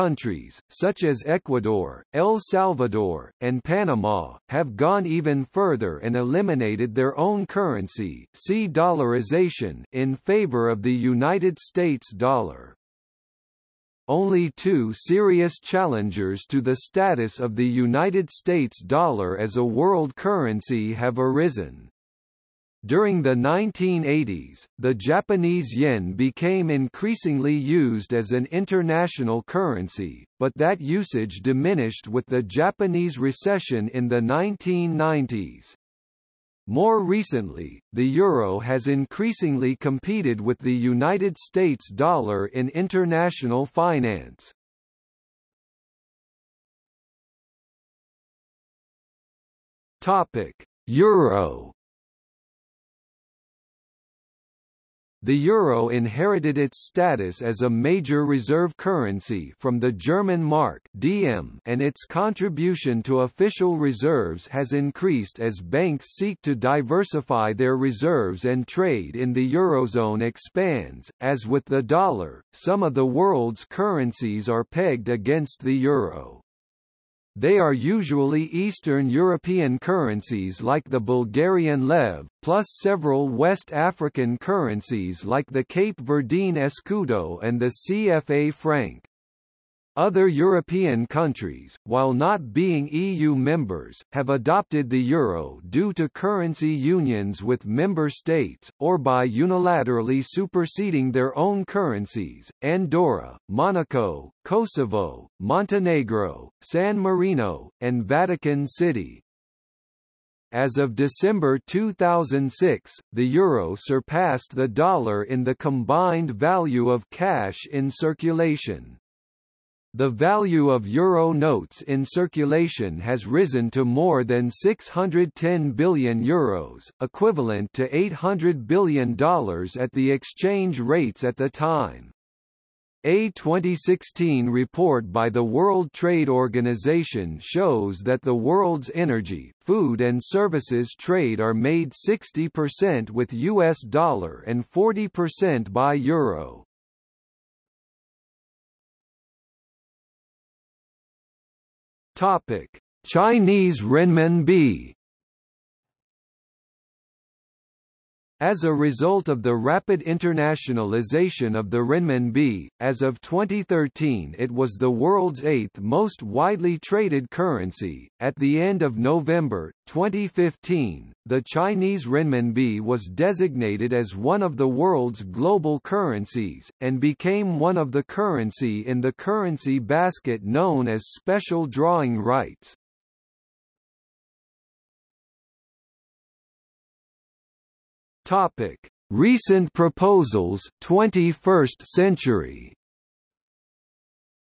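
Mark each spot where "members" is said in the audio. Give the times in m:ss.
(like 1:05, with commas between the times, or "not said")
1:33, 1:37.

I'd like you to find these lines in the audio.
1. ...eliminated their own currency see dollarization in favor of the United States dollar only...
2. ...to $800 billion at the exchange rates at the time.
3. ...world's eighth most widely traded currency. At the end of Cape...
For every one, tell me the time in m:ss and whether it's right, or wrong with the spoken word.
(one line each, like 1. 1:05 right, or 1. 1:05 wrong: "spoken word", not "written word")
1. 0:06 right
2. 2:07 right
3. 2:44 wrong: "November", not "Cape".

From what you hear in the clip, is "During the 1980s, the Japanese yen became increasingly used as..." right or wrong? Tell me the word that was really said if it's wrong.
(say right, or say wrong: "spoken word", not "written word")
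right.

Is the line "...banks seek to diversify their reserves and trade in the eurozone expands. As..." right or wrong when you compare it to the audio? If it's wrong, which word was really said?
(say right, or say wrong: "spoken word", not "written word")
right.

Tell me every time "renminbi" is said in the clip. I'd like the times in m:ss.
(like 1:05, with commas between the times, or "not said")
2:33, 2:41, 2:52.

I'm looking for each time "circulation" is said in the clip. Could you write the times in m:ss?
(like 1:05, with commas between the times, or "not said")
1:57, 2:02.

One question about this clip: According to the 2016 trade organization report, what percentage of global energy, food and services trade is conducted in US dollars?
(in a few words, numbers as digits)
60%.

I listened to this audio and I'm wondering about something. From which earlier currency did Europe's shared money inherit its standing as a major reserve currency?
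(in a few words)
German mark.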